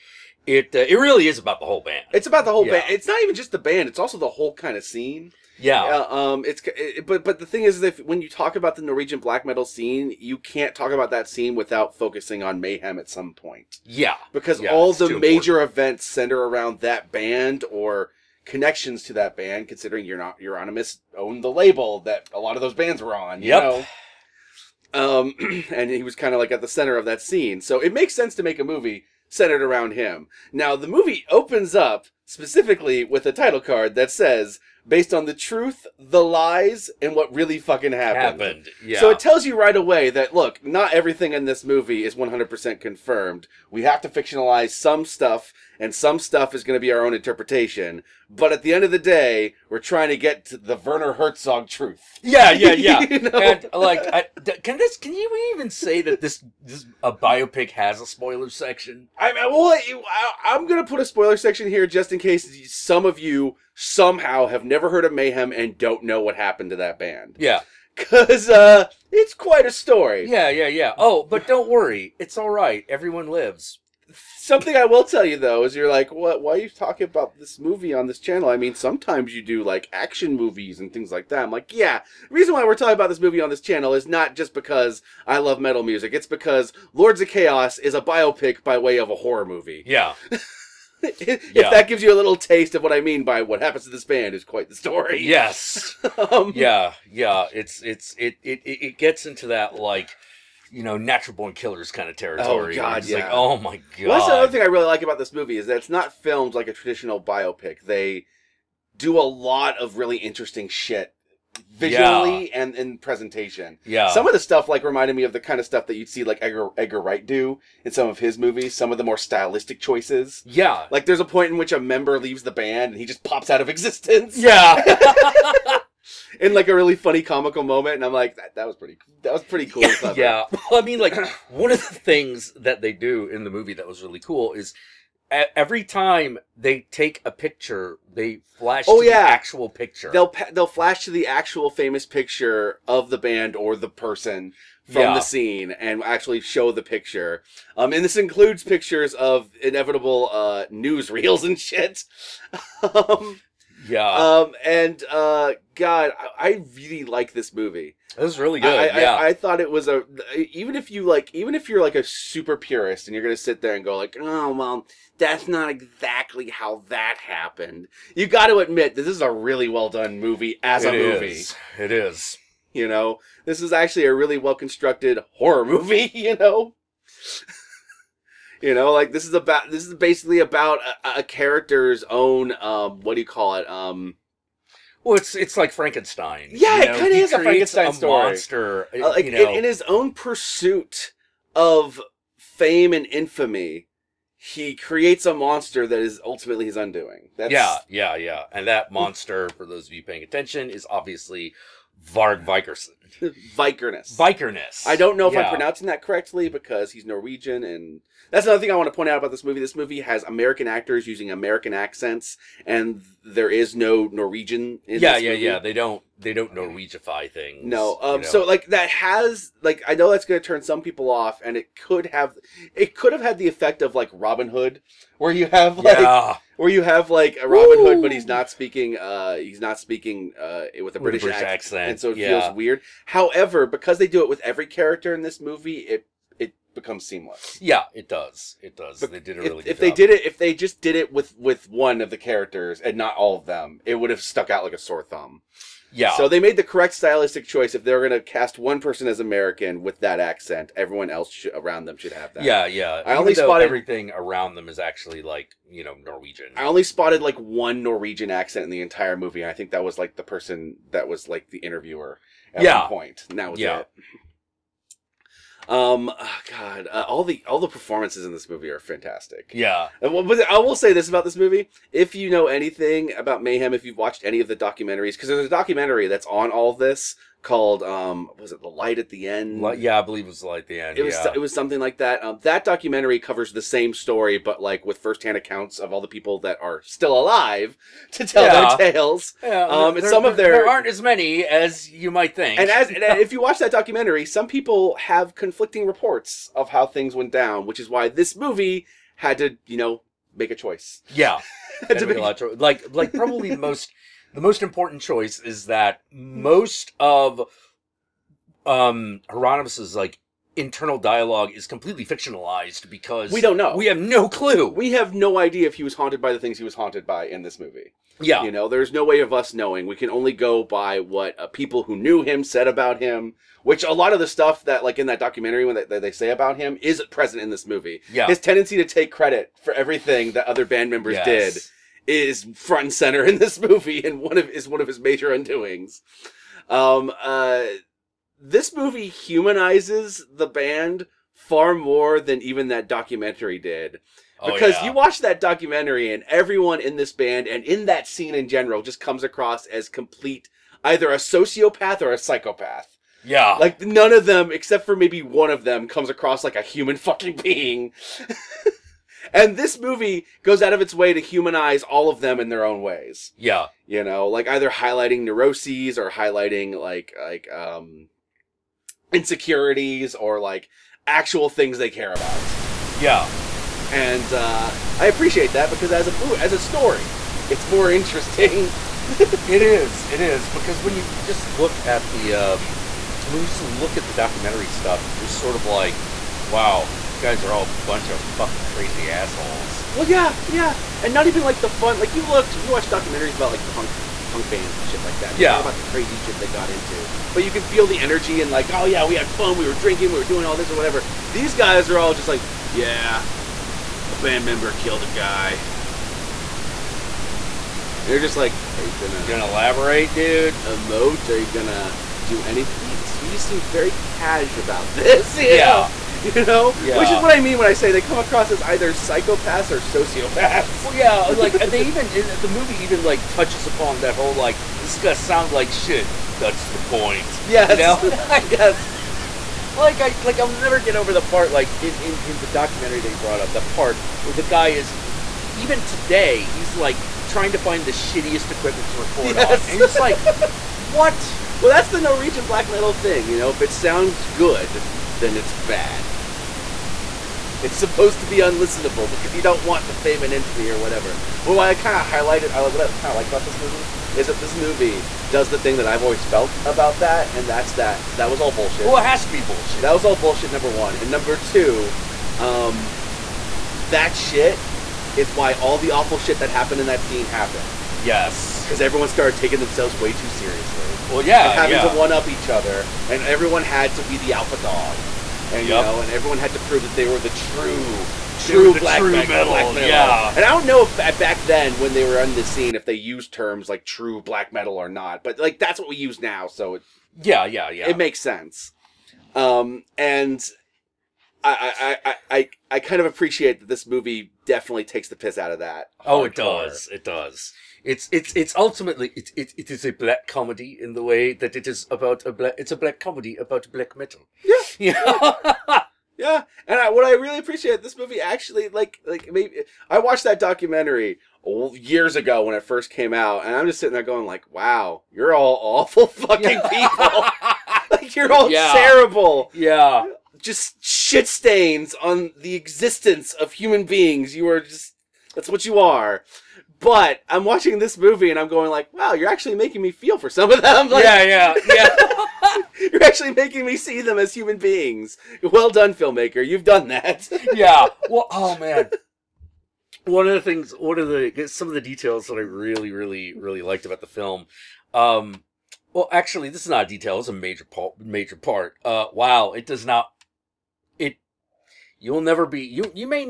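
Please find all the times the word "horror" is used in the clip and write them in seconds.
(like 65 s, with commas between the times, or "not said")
89 s, 175 s.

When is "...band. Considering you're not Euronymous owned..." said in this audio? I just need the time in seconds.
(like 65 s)
19 s.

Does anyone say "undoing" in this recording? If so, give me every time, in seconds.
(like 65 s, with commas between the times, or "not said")
196 s, 335 s.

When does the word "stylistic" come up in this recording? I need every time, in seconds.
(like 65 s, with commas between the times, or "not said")
119 s, 246 s.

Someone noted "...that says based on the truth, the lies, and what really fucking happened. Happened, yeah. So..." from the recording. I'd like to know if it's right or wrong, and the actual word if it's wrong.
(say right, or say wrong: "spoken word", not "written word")
right.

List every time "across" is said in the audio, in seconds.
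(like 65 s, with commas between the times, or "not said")
349 s, 356 s, 418 s.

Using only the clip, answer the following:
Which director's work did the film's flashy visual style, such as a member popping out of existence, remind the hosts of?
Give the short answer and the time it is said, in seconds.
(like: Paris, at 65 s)
Edgar Wright, at 116 s.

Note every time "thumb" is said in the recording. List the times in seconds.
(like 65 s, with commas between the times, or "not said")
245 s.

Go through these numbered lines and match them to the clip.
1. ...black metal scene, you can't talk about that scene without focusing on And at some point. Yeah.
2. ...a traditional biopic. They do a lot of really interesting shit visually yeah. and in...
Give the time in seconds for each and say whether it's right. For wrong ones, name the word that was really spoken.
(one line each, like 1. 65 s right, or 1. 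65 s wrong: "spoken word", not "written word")
1. 9 s wrong: "Mayhem", not "And"
2. 106 s right.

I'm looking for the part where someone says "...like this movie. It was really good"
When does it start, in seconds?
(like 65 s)
157 s.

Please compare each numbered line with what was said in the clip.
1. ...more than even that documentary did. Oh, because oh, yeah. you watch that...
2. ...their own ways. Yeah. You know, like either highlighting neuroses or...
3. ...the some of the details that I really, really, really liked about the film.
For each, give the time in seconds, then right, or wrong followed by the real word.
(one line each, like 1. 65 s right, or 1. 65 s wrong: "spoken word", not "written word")
1. 341 s right
2. 362 s right
3. 541 s right.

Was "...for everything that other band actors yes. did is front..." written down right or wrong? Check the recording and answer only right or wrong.
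wrong.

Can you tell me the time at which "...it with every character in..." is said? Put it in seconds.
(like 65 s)
234 s.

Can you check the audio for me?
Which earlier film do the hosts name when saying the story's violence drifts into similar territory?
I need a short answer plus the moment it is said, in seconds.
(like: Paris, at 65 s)
Natural Born Killers, at 100 s.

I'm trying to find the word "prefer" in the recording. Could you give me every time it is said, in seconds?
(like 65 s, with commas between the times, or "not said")
not said.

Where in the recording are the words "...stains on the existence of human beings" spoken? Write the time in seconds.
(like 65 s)
521 s.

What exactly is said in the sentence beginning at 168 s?
You got to admit this is a really well done movie as it a movie.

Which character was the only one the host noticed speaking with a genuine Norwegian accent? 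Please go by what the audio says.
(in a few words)
The interviewer.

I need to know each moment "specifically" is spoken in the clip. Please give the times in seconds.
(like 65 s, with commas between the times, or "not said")
32 s.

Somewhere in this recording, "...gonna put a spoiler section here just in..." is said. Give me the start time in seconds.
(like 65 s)
60 s.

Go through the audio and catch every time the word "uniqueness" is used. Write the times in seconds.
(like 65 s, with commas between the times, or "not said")
not said.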